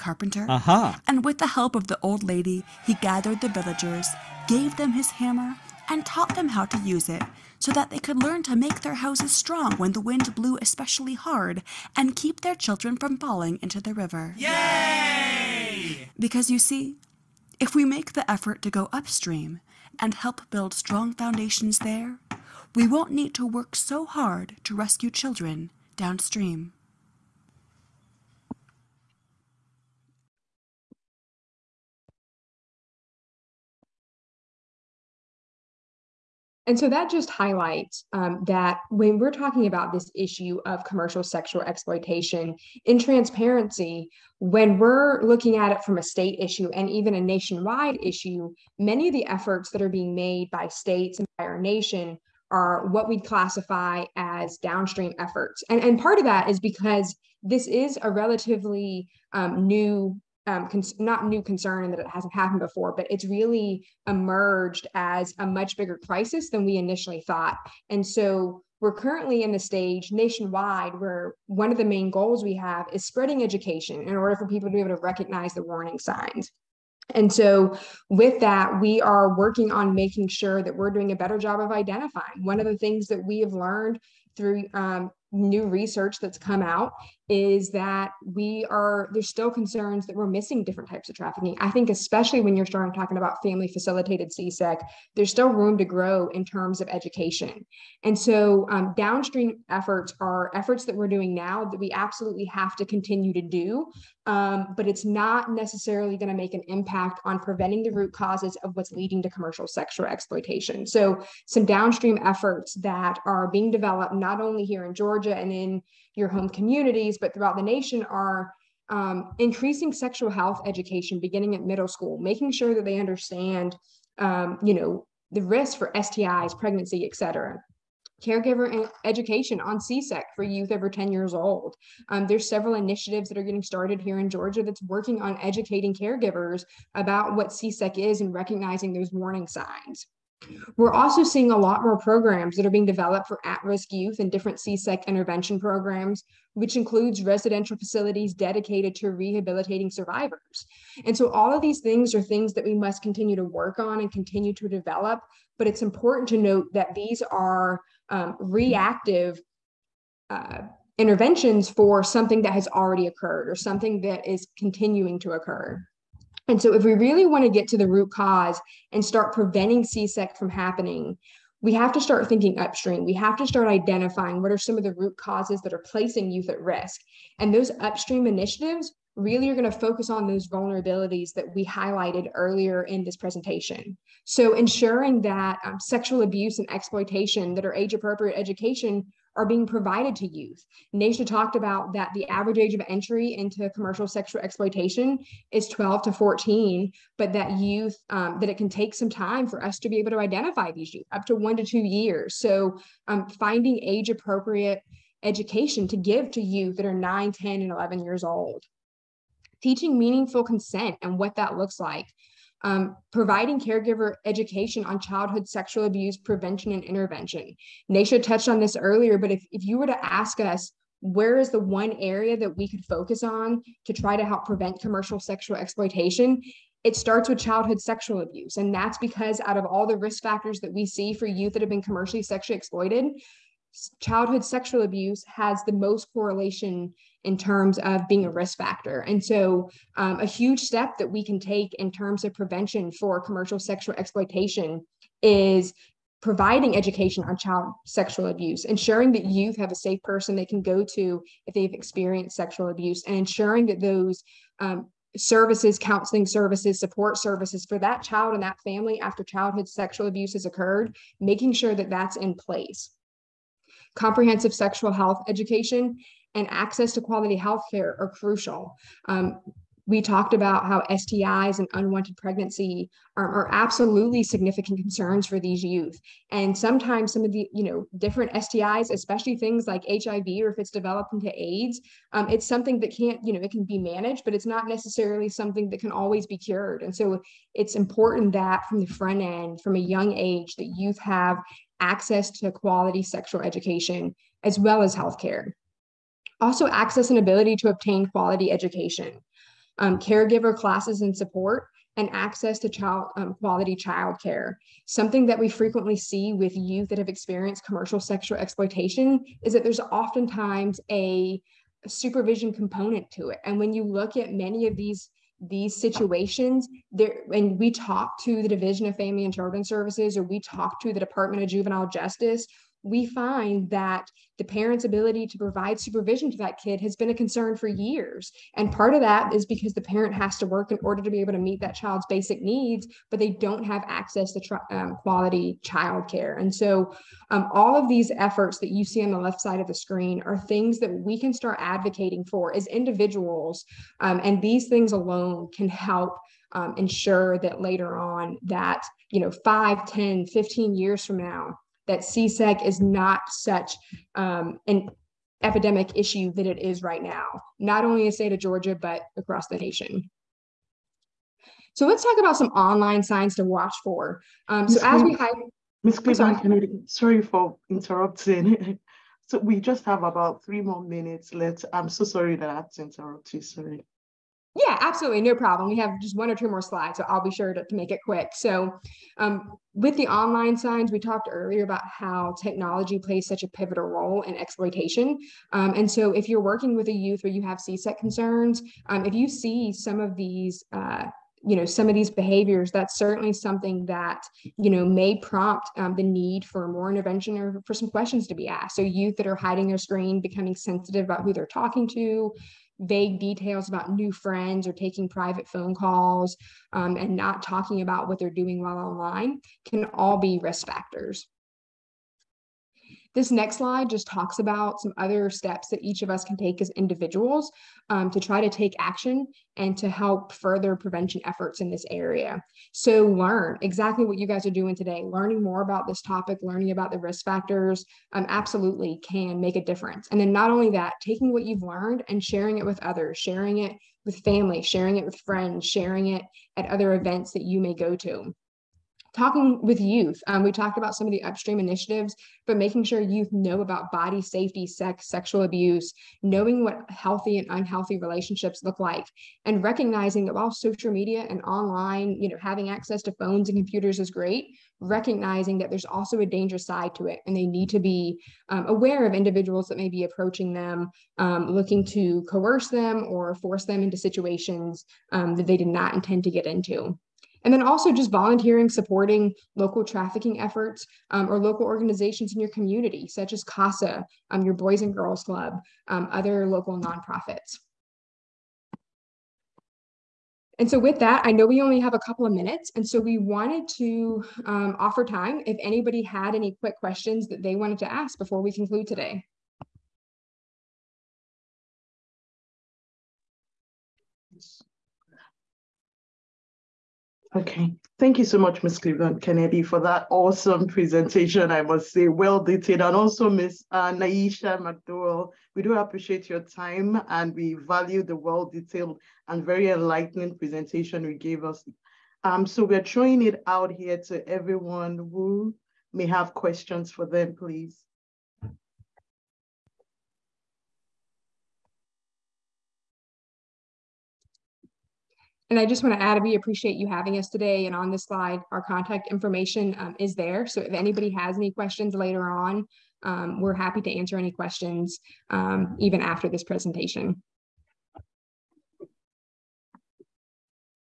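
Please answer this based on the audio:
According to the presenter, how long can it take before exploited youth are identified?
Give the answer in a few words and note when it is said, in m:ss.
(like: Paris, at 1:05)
1 to 2 years, at 3:21.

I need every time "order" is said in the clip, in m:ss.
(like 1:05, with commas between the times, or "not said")
1:14, 5:30.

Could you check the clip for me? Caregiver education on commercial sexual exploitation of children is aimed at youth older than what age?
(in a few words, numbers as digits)
10.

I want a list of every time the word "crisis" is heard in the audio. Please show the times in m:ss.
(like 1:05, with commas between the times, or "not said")
1:06.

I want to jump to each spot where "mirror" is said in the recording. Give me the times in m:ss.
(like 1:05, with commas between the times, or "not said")
not said.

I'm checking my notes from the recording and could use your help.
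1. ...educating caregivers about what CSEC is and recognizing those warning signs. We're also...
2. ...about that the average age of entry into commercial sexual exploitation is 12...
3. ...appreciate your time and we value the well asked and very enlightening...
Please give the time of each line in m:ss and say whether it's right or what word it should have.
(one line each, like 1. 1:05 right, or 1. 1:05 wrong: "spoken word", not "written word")
1. 2:15 right
2. 3:11 right
3. 8:25 wrong: "detailed", not "asked".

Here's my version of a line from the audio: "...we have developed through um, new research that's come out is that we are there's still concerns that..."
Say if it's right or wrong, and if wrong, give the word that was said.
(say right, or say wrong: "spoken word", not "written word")
wrong: "learned", not "developed".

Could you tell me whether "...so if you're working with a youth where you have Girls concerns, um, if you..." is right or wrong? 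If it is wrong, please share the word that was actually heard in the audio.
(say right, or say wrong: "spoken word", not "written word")
wrong: "CSEC", not "Girls".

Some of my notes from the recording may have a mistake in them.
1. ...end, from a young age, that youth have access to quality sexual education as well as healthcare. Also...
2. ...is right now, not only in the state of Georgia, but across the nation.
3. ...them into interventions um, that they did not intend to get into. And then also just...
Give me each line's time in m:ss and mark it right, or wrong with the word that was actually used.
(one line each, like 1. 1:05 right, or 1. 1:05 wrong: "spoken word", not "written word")
1. 4:49 right
2. 5:56 right
3. 7:43 wrong: "situations", not "interventions".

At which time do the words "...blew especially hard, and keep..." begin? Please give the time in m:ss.
0:10.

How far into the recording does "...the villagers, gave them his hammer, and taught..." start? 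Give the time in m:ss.
0:03.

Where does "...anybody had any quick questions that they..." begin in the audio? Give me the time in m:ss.
8:05.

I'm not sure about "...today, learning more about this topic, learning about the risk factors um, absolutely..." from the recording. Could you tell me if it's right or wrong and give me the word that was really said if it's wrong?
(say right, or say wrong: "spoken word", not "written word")
right.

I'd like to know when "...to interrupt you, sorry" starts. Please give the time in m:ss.
6:12.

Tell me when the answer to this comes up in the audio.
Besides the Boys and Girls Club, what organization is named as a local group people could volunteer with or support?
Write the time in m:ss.
7:53.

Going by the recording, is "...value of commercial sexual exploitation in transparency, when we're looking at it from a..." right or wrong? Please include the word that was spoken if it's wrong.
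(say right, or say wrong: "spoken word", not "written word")
wrong: "issue", not "value".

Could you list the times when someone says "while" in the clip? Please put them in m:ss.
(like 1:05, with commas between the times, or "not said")
6:48, 7:30.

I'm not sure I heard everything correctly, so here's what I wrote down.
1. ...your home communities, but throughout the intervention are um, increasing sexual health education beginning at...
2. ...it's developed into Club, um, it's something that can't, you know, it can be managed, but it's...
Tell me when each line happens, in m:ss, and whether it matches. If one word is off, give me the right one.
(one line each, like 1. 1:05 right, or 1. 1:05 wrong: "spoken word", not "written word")
1. 1:56 wrong: "nation", not "intervention"
2. 4:40 wrong: "AIDS", not "Club".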